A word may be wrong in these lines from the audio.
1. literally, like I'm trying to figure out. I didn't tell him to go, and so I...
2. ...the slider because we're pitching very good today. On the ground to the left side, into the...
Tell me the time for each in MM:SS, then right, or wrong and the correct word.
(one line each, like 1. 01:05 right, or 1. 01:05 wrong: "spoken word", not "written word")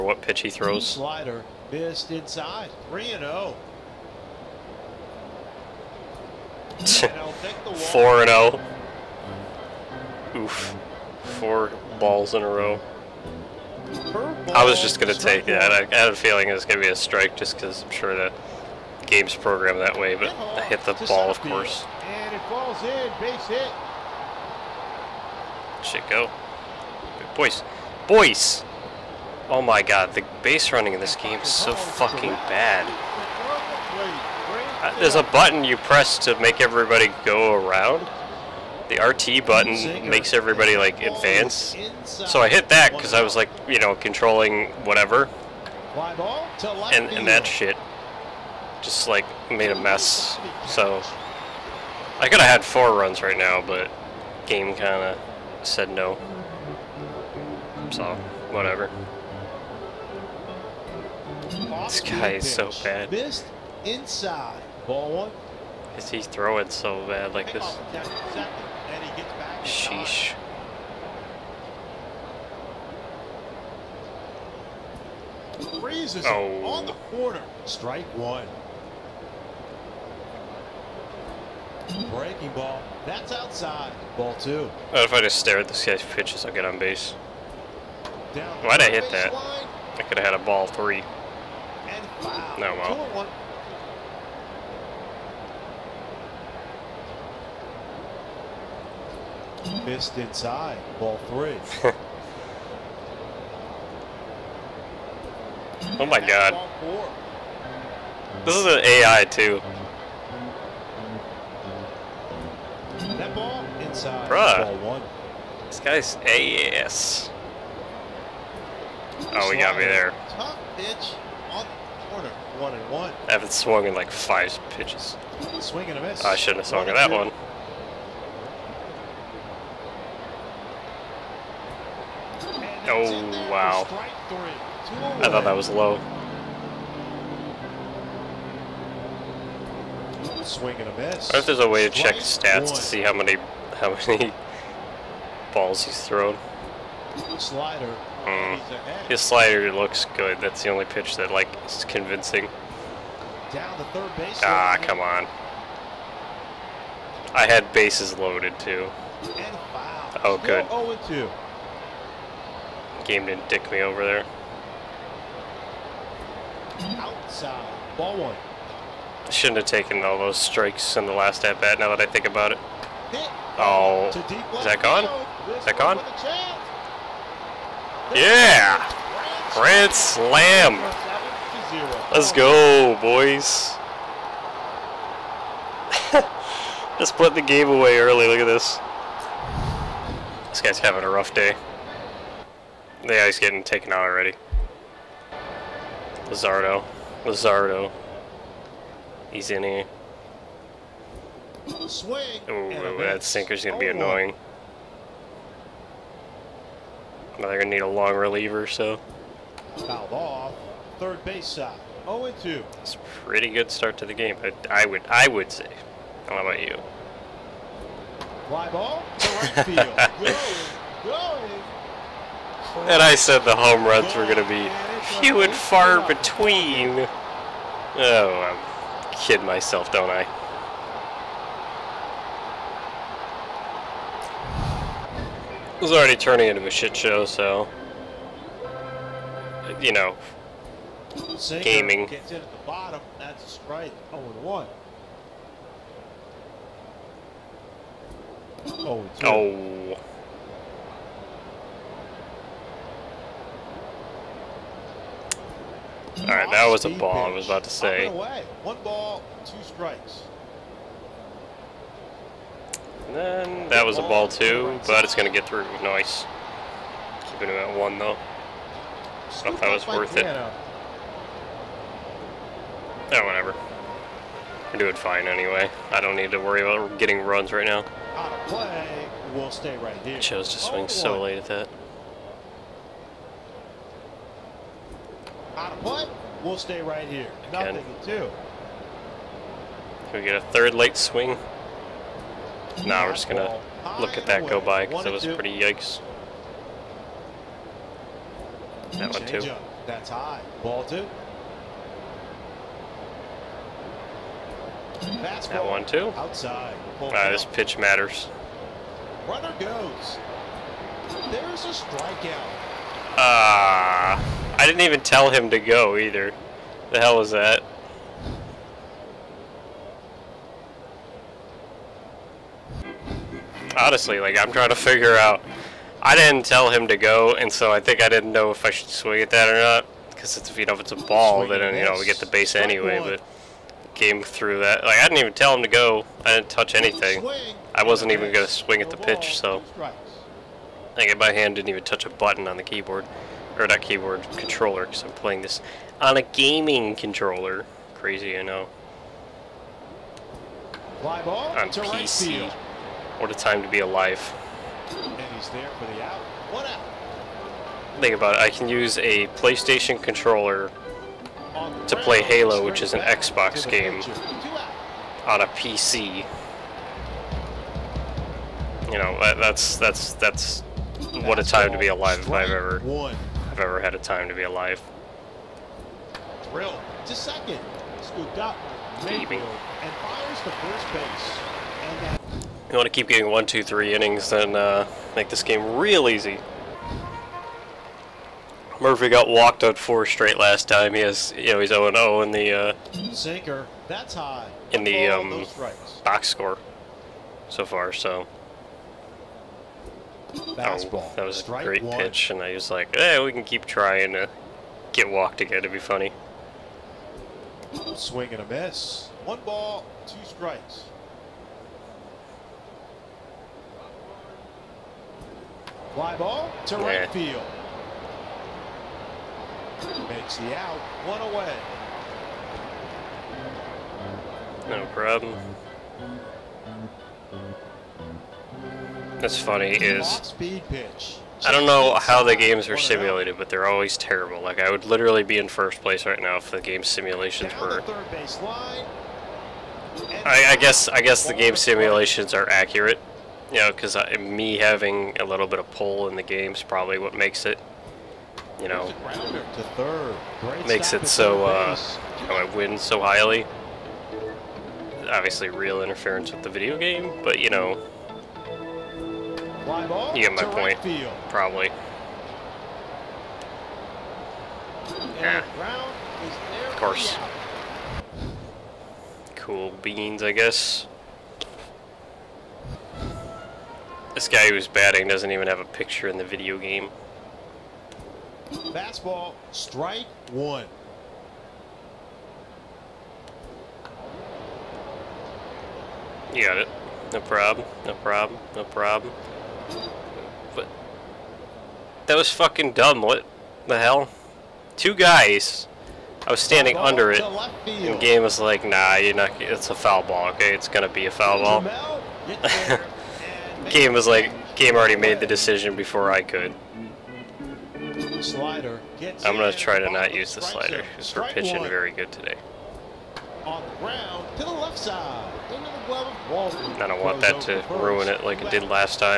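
1. 05:23 wrong: "honestly", not "literally"
2. 08:30 right.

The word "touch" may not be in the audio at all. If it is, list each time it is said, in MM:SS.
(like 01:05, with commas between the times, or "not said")
05:36, 05:41.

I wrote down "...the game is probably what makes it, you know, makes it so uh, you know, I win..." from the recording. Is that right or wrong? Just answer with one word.
right.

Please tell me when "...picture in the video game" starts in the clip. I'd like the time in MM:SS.
07:55.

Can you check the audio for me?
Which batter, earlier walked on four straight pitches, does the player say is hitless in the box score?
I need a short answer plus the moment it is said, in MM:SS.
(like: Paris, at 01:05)
Murphy, at 06:28.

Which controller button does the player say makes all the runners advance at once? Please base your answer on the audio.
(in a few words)
RT.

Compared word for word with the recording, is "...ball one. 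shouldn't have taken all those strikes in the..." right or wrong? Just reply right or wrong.
right.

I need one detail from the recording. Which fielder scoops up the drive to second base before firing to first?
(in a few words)
Mayfield.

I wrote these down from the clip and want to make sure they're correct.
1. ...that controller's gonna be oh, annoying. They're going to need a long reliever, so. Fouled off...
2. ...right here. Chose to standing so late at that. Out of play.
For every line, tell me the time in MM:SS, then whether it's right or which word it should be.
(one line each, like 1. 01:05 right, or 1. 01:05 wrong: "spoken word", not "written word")
1. 03:22 wrong: "sinker", not "controller"
2. 04:39 wrong: "swing", not "standing".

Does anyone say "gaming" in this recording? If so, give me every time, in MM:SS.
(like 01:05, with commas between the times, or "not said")
04:01, 05:46.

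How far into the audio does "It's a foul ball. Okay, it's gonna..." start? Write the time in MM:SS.
08:19.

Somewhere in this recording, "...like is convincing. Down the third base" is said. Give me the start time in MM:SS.
02:31.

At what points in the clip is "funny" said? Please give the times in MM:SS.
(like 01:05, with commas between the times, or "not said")
06:45, 07:09.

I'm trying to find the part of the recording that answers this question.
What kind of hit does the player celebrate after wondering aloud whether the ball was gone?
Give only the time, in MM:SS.
02:59.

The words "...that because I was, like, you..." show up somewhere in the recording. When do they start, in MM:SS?
00:42.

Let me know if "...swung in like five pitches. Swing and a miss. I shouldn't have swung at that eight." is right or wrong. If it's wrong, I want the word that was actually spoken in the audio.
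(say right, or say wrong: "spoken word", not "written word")
wrong: "two", not "eight".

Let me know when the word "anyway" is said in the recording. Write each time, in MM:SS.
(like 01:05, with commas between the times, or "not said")
04:35, 05:32.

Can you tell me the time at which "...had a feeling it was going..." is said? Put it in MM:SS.
00:15.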